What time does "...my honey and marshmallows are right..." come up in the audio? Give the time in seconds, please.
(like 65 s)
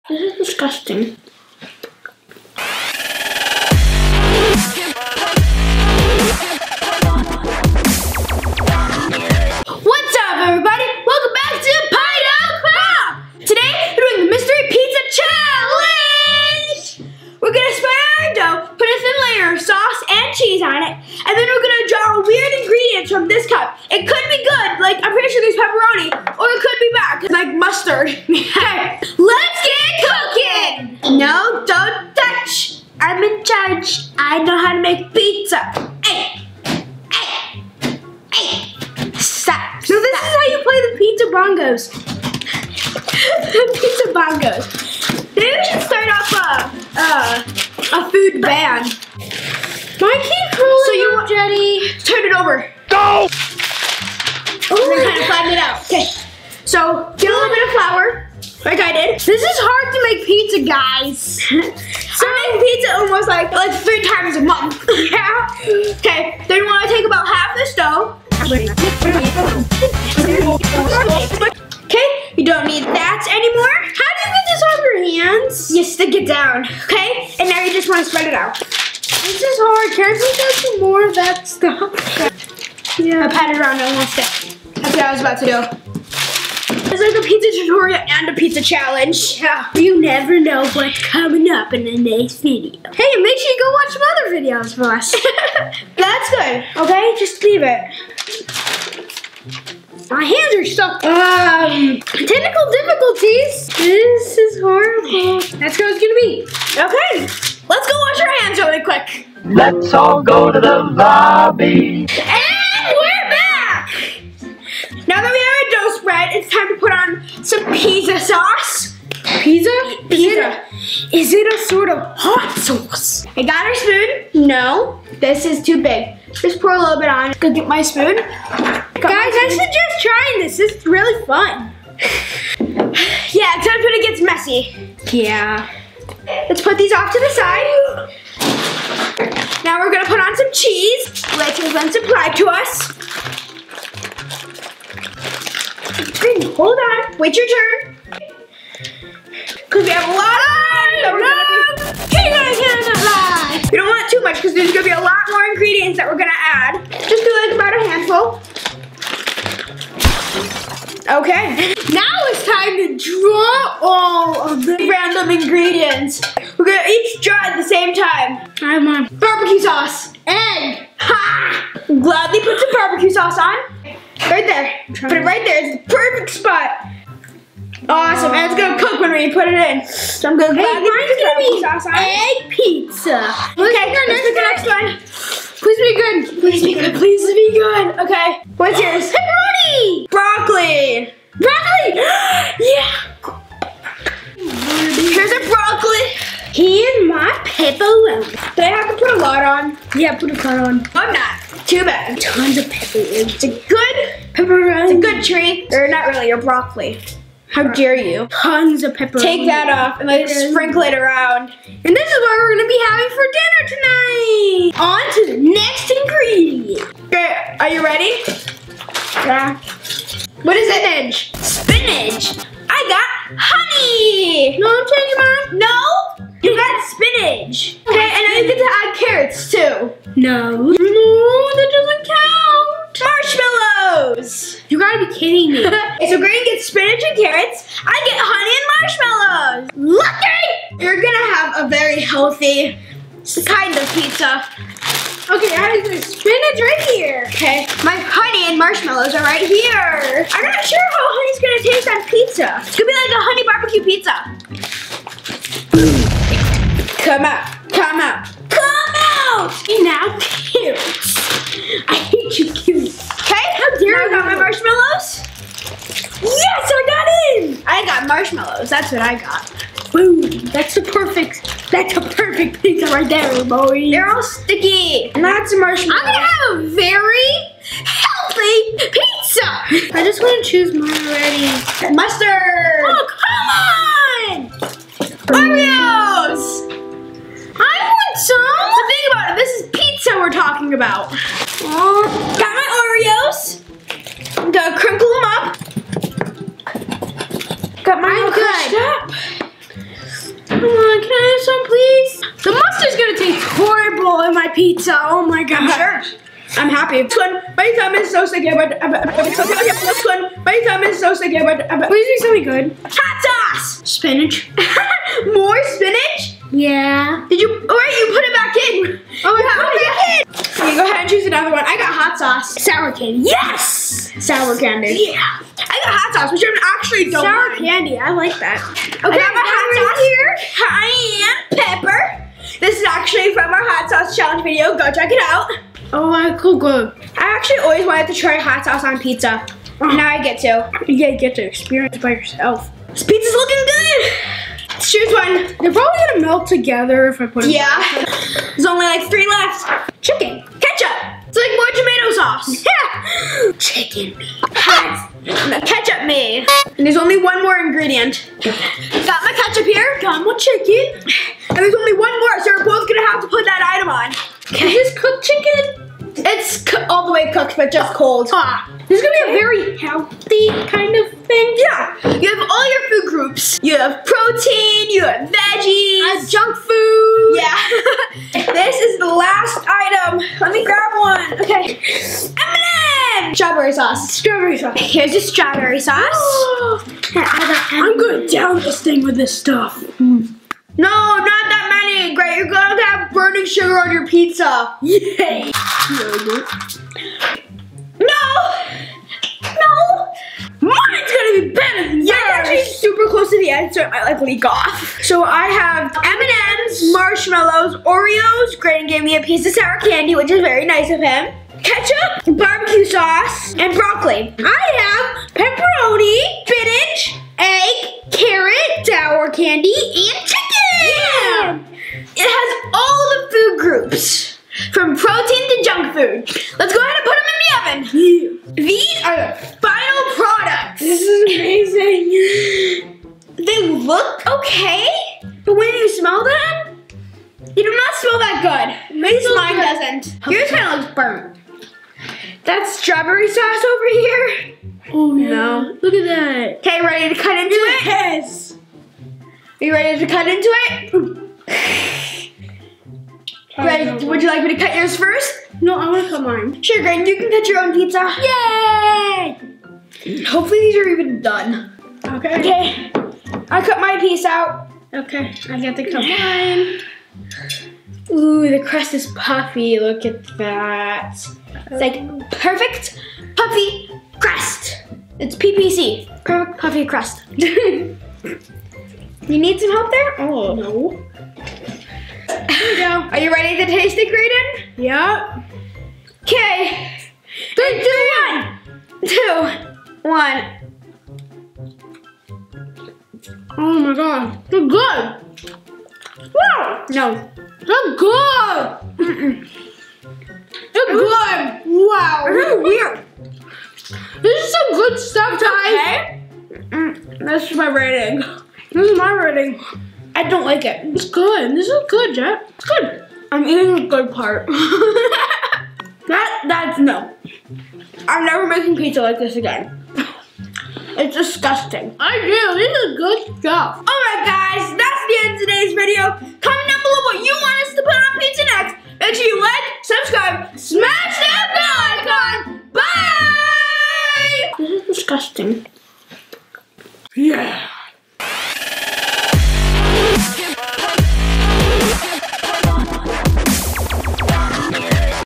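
247 s.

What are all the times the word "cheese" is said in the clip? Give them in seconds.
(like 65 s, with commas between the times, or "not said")
20 s, 140 s.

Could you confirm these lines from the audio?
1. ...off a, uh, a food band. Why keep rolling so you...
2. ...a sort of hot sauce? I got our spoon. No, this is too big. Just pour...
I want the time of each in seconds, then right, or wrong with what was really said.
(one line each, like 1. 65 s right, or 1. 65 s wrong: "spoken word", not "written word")
1. 46 s right
2. 121 s right.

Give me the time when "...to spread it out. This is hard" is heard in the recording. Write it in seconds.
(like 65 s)
78 s.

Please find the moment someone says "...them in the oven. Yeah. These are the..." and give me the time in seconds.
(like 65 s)
427 s.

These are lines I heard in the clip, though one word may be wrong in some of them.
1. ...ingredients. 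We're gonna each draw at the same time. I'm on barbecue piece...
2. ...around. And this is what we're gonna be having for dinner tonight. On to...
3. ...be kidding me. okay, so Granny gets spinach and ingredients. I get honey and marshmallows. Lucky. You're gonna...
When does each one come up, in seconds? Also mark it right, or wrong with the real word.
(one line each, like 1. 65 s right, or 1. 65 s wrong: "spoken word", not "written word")
1. 165 s wrong: "sauce", not "piece"
2. 210 s right
3. 235 s wrong: "carrots", not "ingredients".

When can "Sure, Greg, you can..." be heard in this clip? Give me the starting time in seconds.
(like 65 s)
456 s.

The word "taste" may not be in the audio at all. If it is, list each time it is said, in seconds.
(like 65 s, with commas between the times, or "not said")
251 s, 483 s.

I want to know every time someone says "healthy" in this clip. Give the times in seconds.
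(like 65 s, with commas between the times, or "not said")
242 s, 277 s, 369 s.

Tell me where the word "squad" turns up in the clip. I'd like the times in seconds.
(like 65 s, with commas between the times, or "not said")
not said.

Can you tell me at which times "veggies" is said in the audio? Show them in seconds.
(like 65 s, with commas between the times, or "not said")
375 s.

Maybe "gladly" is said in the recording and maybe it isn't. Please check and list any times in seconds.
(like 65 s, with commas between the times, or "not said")
171 s, 180 s.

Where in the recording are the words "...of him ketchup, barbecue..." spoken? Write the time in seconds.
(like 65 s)
410 s.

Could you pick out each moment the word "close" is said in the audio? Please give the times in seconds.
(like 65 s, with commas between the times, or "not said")
403 s.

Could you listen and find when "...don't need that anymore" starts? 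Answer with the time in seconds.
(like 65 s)
72 s.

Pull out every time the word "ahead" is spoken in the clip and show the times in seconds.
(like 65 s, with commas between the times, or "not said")
320 s, 426 s.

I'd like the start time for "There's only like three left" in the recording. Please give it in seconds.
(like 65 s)
348 s.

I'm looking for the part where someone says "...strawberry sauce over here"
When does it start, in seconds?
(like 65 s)
442 s.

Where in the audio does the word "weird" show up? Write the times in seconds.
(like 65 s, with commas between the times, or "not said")
22 s, 502 s.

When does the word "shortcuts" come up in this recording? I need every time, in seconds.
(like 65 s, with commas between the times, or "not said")
not said.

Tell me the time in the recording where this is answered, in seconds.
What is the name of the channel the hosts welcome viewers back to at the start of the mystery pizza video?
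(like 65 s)
11 s.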